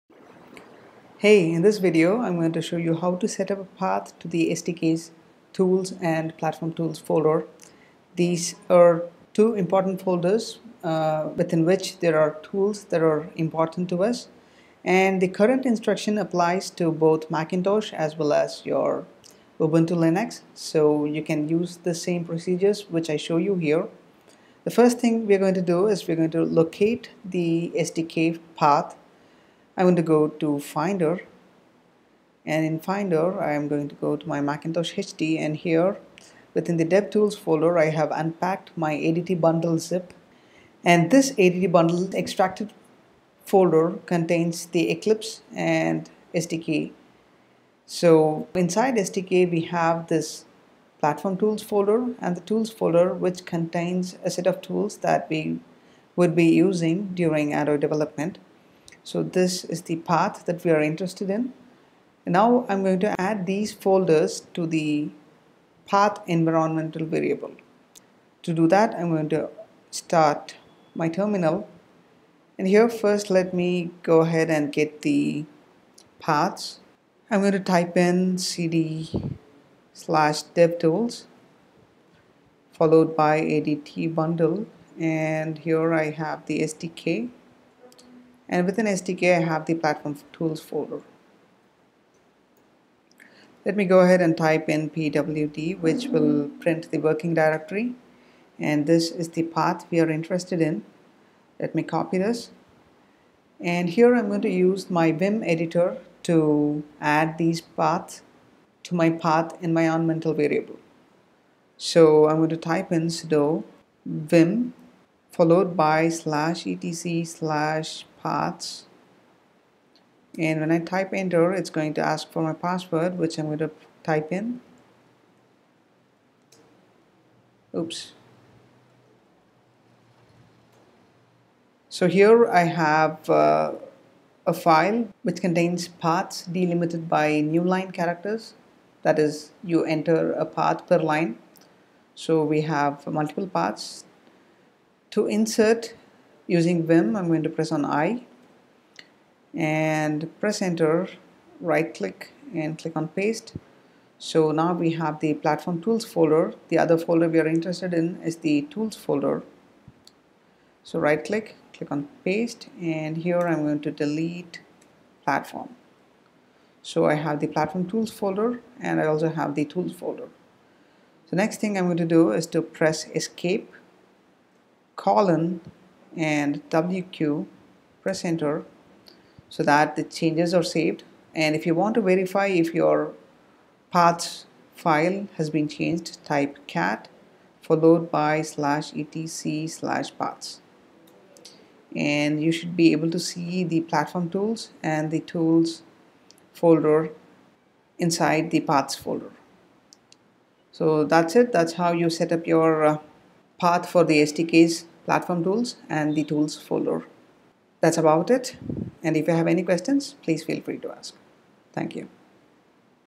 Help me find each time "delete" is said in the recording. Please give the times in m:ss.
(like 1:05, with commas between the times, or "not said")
2:43.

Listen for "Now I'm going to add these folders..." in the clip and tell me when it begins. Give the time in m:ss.
1:02.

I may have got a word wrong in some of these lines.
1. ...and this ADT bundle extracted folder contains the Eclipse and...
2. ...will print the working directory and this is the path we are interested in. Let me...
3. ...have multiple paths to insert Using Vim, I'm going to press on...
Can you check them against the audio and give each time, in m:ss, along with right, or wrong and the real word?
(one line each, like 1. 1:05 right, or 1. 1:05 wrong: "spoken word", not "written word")
1. 0:40 right
2. 1:36 right
3. 2:22 right.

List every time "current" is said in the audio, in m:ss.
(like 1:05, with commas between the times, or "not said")
0:15.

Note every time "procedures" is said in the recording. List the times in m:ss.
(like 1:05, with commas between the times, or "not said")
0:22.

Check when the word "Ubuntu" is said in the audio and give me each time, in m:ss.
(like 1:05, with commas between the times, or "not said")
0:19.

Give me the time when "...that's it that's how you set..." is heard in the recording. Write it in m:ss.
3:21.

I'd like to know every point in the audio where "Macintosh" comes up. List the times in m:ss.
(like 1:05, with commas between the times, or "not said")
0:17, 0:34.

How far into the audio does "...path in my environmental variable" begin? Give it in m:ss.
1:49.